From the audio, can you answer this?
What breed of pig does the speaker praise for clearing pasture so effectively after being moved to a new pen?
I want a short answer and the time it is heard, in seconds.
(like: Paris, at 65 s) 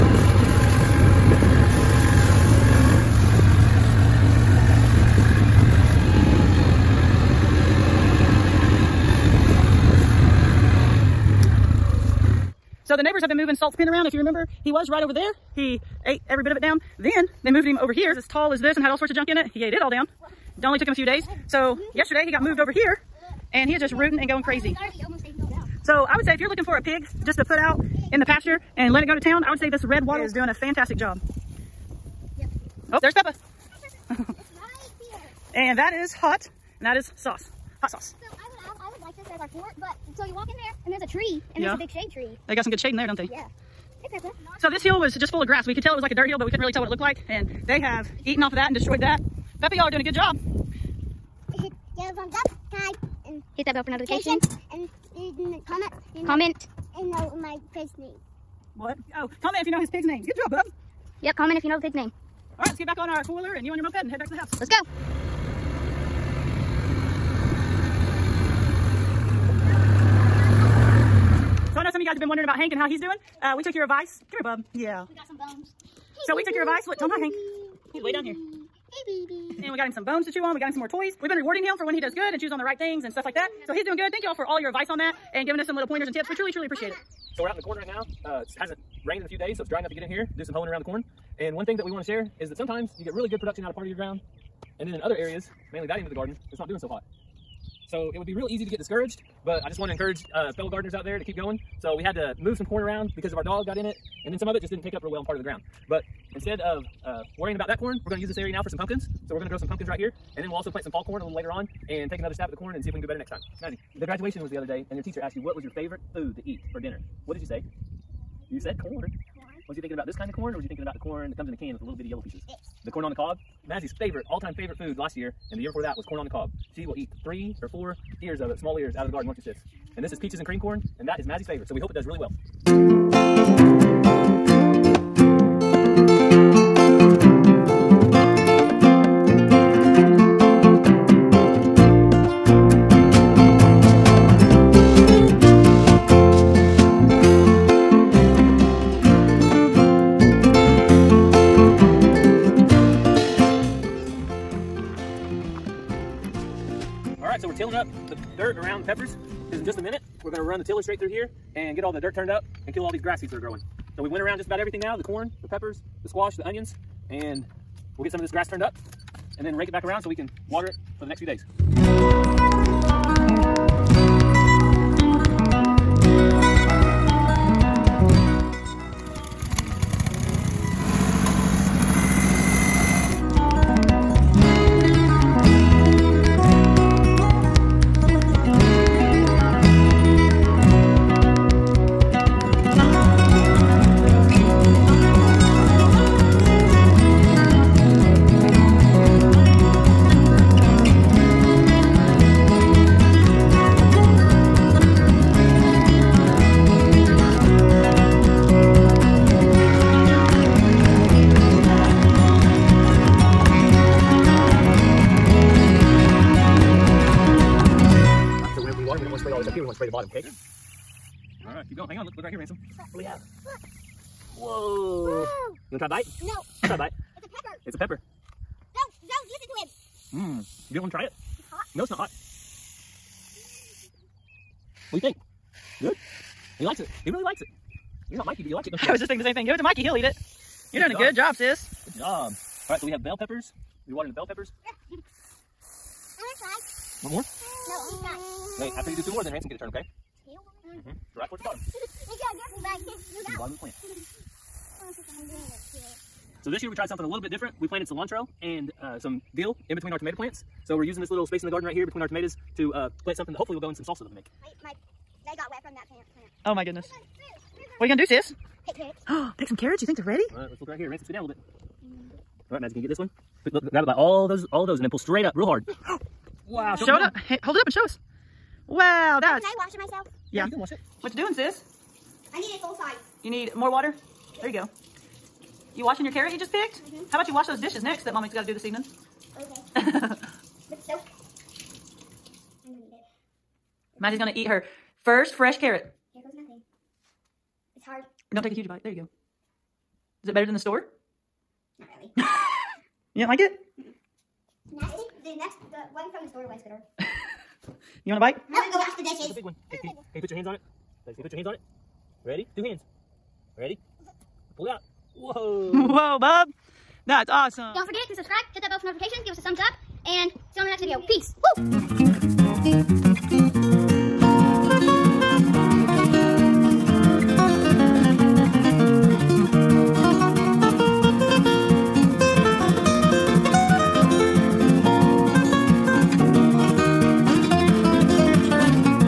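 Red wattle, at 29 s.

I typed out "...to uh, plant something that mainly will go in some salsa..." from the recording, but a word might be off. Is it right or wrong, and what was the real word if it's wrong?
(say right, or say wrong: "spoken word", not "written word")
wrong: "hopefully", not "mainly".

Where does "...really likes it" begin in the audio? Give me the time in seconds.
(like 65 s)
237 s.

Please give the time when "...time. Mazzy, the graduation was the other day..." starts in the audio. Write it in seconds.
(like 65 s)
113 s.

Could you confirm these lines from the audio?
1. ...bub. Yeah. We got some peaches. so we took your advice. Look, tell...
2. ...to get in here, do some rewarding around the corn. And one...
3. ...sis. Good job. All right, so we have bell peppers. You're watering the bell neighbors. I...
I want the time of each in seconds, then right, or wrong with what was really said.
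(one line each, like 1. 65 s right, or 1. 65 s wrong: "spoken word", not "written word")
1. 74 s wrong: "bones", not "peaches"
2. 89 s wrong: "hoeing", not "rewarding"
3. 241 s wrong: "peppers", not "neighbors".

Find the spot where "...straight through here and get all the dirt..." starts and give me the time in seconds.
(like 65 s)
160 s.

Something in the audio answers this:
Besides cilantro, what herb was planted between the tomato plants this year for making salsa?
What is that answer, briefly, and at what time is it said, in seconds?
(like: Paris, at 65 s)
Dill, at 259 s.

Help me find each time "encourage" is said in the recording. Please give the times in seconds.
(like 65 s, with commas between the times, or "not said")
99 s.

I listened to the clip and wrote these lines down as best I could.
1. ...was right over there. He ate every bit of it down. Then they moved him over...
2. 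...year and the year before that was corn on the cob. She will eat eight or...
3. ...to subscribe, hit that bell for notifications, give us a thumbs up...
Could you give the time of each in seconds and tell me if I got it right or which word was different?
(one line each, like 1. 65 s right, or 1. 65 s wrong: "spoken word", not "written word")
1. 14 s right
2. 125 s wrong: "three", not "eight"
3. 318 s right.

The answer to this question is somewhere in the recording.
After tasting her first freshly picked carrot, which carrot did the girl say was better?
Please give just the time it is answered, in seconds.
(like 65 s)
305 s.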